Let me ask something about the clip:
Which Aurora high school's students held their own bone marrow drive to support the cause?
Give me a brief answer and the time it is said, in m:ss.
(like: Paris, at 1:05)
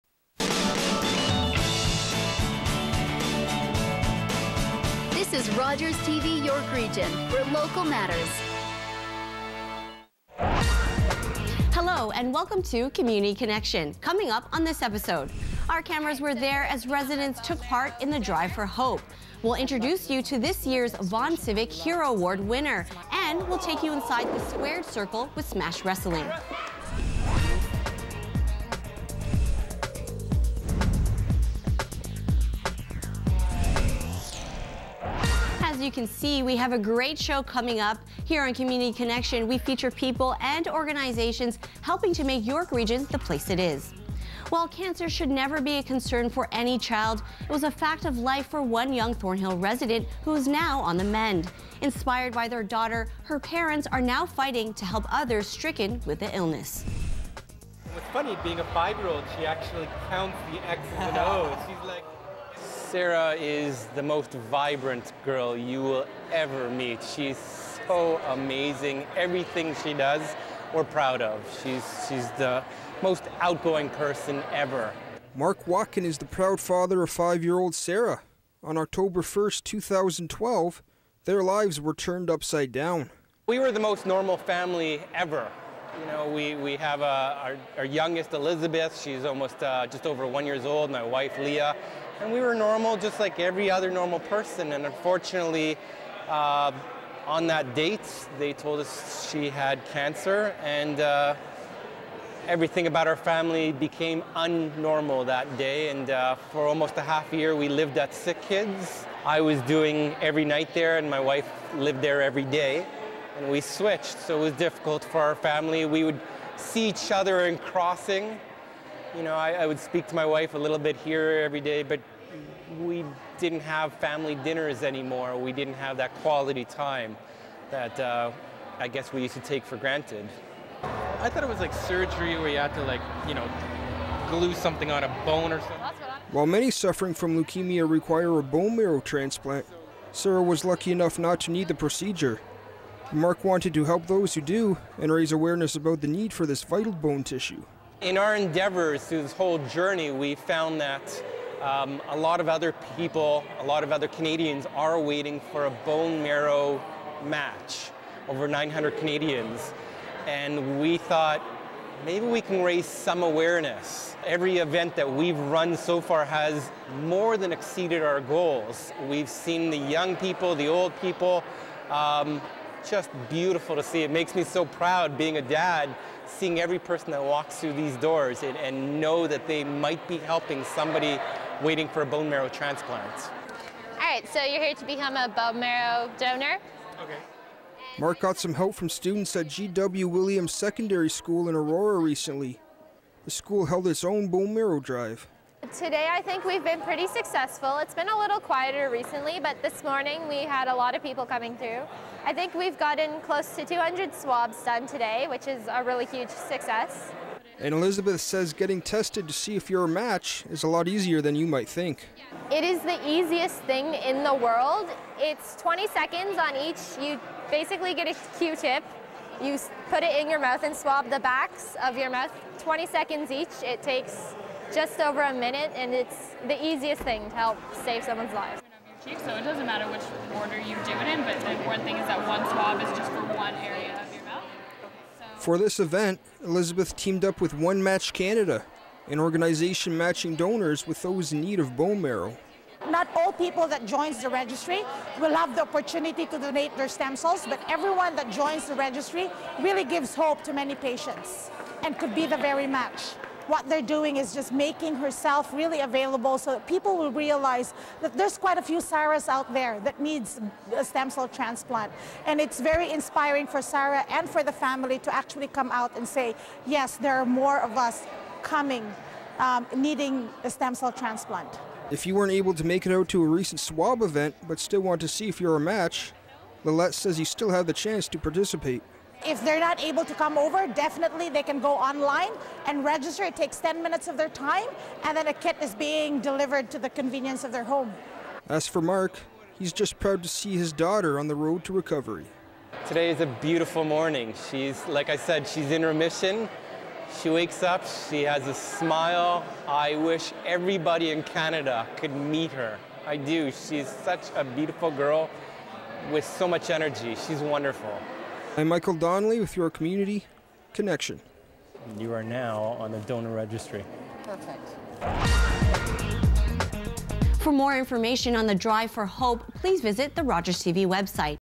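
G.W. Williams Secondary School, at 3:09.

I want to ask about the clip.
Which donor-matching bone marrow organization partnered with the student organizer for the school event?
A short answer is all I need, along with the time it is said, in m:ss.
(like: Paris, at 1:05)
OneMatch Canada, at 3:57.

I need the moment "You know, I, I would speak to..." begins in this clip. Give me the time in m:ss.
1:59.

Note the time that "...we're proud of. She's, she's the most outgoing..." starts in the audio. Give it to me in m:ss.
1:10.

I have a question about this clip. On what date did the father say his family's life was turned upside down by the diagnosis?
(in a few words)
October 1st, 2012.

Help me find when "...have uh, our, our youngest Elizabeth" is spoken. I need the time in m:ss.
1:26.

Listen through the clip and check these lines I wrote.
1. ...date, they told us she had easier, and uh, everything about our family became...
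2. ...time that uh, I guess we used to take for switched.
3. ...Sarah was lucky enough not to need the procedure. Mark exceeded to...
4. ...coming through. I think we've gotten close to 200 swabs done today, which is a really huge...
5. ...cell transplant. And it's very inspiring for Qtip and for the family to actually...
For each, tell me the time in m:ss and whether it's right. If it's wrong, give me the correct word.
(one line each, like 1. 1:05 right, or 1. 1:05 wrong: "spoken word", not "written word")
1. 1:37 wrong: "cancer", not "easier"
2. 2:06 wrong: "granted", not "switched"
3. 2:20 wrong: "wanted", not "exceeded"
4. 3:21 right
5. 4:21 wrong: "Sarah", not "Qtip".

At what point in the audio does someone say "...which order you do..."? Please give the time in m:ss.
3:49.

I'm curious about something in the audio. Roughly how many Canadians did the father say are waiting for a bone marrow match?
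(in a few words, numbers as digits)
over 900.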